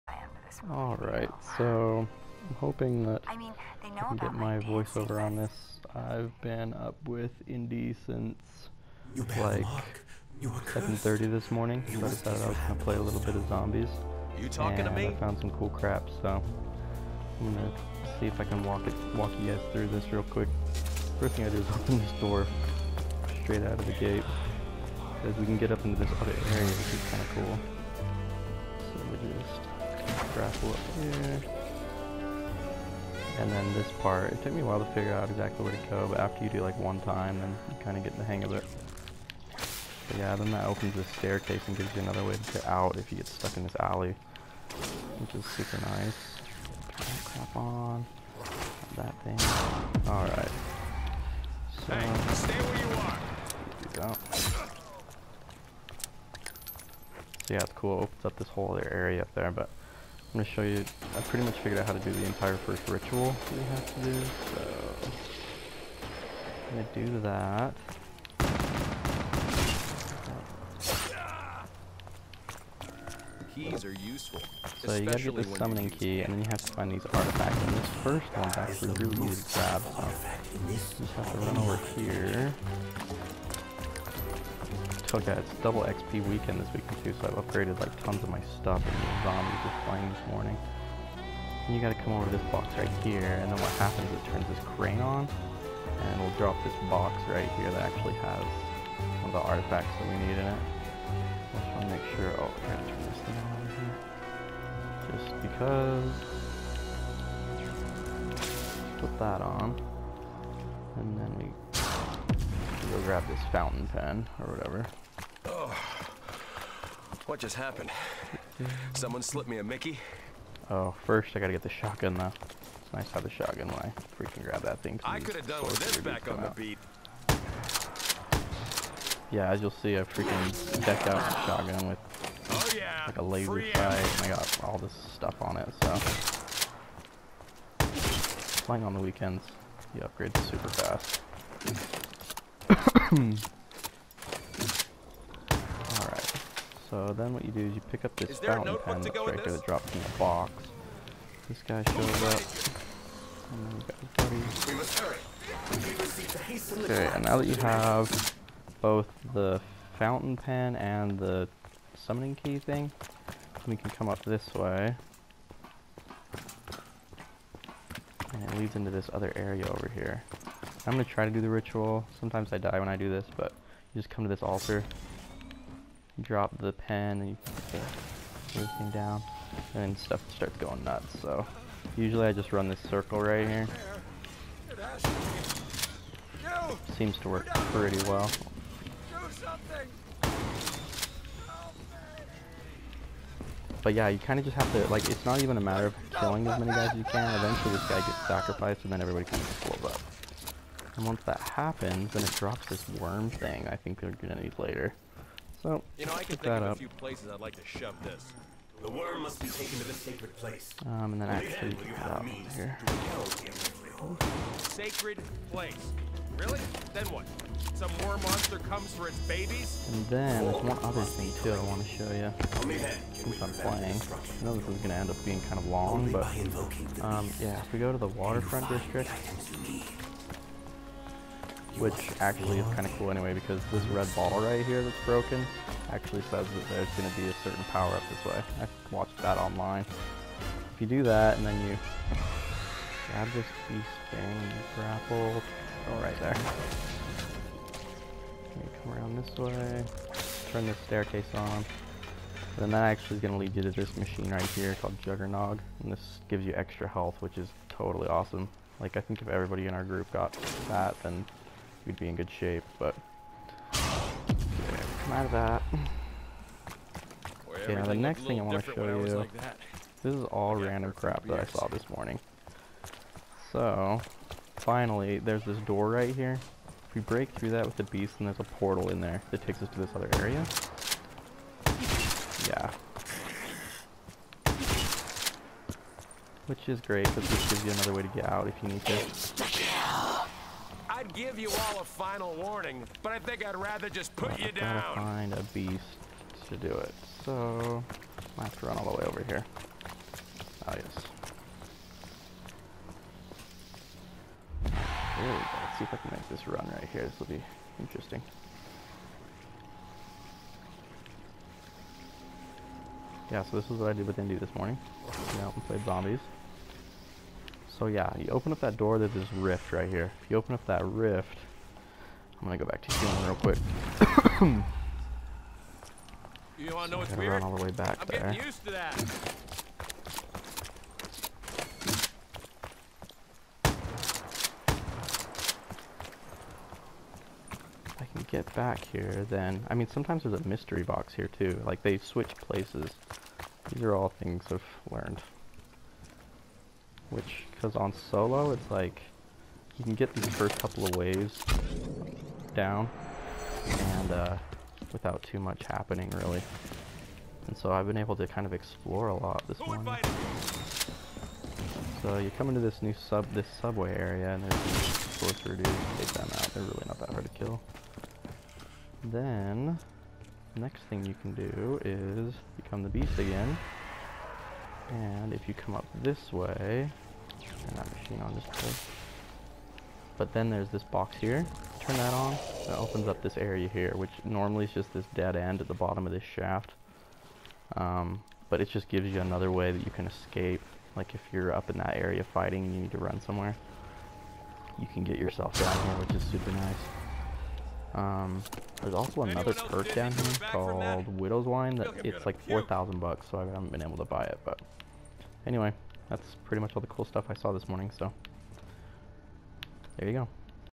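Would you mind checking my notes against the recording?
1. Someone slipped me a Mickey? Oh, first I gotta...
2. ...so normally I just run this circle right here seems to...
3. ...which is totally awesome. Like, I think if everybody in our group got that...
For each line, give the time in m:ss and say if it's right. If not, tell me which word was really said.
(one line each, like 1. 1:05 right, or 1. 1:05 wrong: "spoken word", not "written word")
1. 1:58 right
2. 3:01 wrong: "usually", not "normally"
3. 4:17 right.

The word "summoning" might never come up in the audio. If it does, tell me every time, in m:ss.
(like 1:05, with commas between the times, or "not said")
1:15, 2:41.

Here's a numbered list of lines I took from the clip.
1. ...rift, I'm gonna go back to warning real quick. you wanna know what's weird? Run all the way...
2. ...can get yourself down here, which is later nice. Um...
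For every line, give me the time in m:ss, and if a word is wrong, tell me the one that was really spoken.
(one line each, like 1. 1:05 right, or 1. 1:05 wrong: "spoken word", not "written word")
1. 5:20 wrong: "healing", not "warning"
2. 6:34 wrong: "super", not "later".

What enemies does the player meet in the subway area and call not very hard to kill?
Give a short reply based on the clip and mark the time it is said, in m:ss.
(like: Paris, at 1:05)
Sorcerer dudes, at 6:05.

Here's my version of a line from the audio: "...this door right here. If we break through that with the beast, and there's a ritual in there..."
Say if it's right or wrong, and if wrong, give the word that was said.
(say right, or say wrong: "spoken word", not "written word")
wrong: "portal", not "ritual".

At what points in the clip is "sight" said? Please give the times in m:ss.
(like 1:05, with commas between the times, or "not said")
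2:13.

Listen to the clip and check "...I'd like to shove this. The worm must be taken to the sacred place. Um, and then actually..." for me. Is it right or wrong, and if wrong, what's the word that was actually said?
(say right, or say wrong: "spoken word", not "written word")
right.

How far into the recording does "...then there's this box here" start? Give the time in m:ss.
6:20.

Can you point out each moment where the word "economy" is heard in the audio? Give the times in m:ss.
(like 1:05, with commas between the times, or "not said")
not said.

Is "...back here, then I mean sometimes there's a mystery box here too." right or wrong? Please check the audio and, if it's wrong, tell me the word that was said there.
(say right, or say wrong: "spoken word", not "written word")
right.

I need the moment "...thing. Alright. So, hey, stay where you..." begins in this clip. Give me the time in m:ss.
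0:49.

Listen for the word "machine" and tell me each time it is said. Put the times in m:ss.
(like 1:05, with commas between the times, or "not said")
4:13, 6:17.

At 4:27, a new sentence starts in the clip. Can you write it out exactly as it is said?
Okay, yeah, now the next thing I want to show you...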